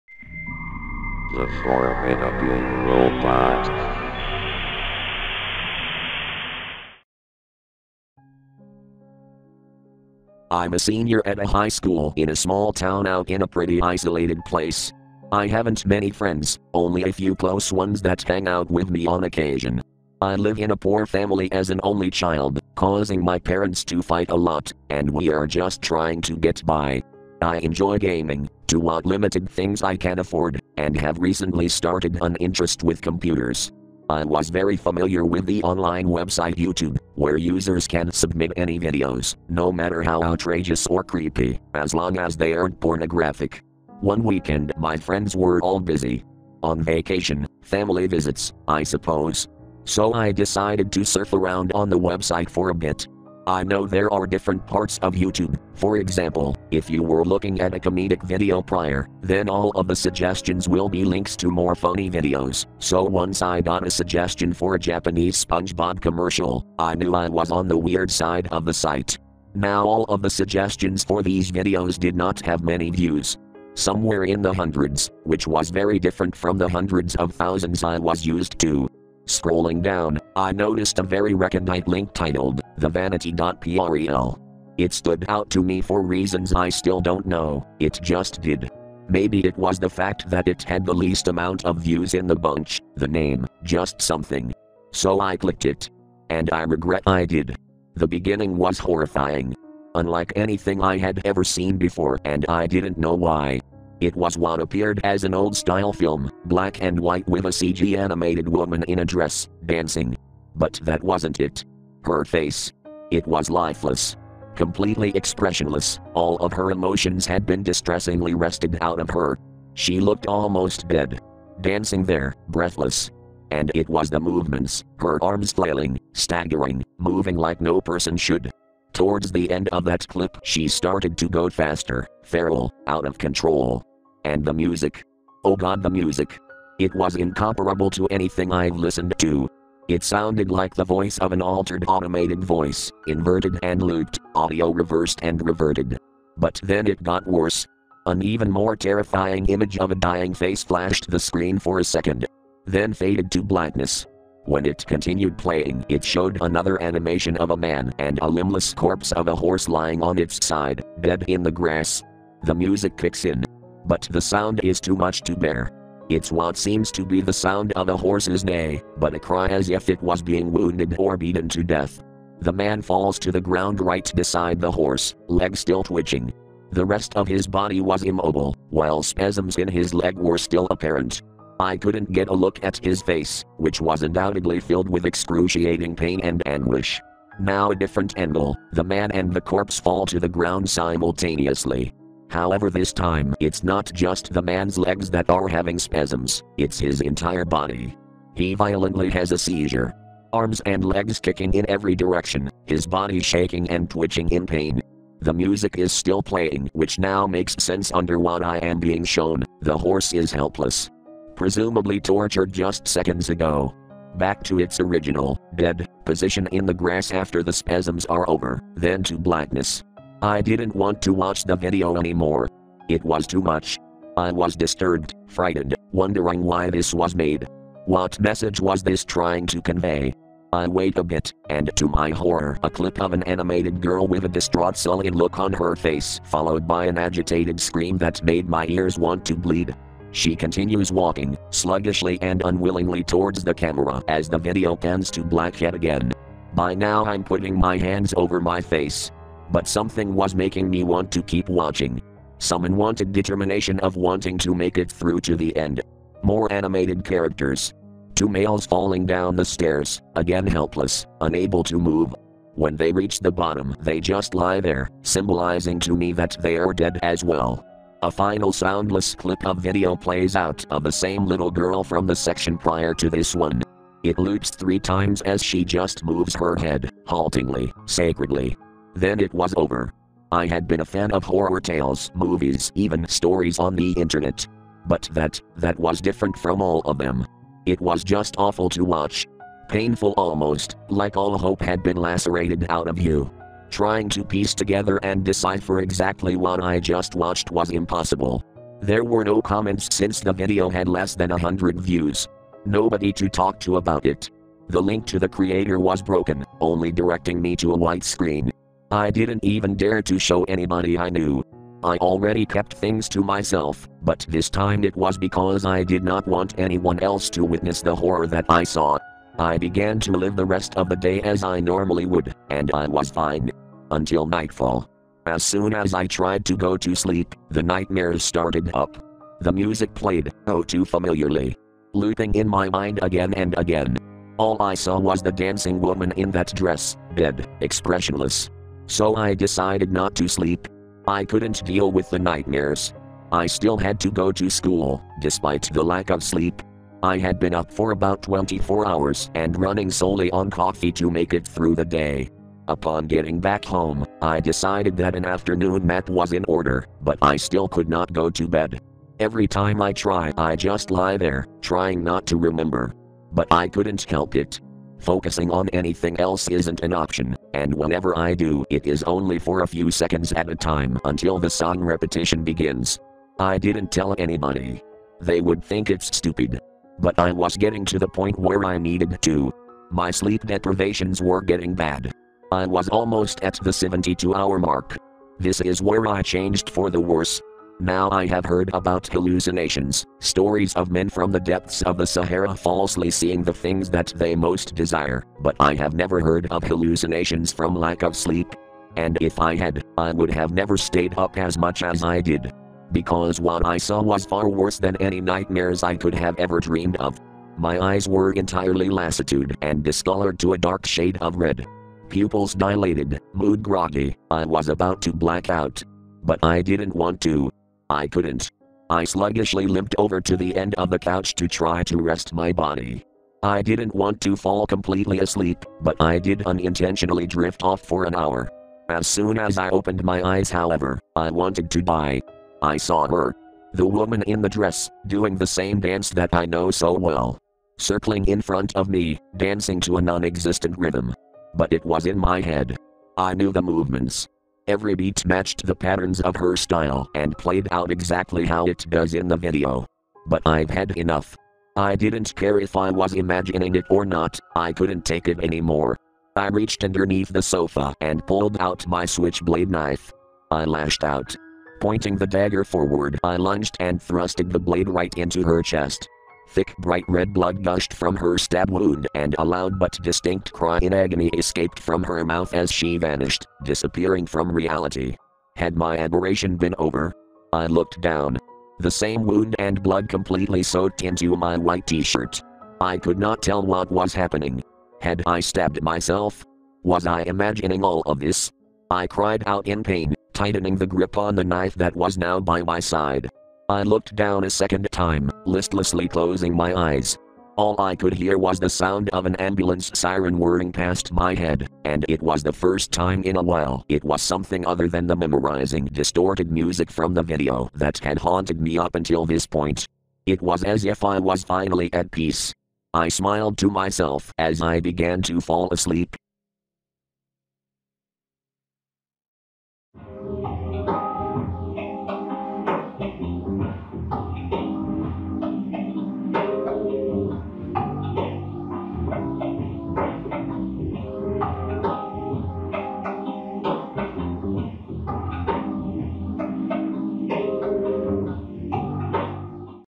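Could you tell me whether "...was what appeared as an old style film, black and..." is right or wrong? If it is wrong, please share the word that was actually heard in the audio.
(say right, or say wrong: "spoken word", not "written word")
right.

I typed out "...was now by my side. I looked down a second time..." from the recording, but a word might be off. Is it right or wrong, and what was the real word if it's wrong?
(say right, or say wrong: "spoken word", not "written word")
right.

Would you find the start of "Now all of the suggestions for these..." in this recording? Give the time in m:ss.
1:09.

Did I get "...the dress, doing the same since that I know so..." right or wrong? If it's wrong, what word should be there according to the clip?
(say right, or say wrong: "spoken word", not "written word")
wrong: "dance", not "since".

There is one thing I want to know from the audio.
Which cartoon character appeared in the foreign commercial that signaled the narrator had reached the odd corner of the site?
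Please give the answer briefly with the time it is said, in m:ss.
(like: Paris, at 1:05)
SpongeBob, at 1:05.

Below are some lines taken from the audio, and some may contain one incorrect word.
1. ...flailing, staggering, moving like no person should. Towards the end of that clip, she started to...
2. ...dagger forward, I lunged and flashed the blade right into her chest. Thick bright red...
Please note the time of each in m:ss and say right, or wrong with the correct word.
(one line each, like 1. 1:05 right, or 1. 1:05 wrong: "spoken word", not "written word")
1. 2:05 right
2. 7:42 wrong: "thrusted", not "flashed".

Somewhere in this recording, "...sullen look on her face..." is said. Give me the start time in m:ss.
3:54.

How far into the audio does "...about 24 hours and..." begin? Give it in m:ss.
5:47.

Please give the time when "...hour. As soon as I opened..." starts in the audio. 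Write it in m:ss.
7:08.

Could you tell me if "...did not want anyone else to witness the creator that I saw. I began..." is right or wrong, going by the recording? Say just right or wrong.
wrong.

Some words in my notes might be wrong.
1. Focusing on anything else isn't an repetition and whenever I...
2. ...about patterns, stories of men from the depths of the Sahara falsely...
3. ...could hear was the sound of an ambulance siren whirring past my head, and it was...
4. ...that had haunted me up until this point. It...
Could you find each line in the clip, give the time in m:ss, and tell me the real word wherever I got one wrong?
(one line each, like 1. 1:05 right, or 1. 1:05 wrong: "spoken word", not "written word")
1. 6:04 wrong: "option", not "repetition"
2. 6:28 wrong: "hallucinations", not "patterns"
3. 8:17 right
4. 8:27 right.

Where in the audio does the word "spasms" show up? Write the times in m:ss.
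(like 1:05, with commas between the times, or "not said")
2:59, 3:15, 3:37.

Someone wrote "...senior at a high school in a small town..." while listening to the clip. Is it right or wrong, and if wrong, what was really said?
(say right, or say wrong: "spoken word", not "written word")
right.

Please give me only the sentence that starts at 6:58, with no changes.
I sluggishly limped over to the end of the couch to try to rest my body.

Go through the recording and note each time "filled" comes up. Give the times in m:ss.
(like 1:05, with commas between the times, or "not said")
3:04.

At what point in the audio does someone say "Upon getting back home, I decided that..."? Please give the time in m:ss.
5:52.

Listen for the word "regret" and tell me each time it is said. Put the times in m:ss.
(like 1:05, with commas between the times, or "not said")
1:36.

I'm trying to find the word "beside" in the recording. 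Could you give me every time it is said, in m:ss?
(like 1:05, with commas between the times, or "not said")
2:54.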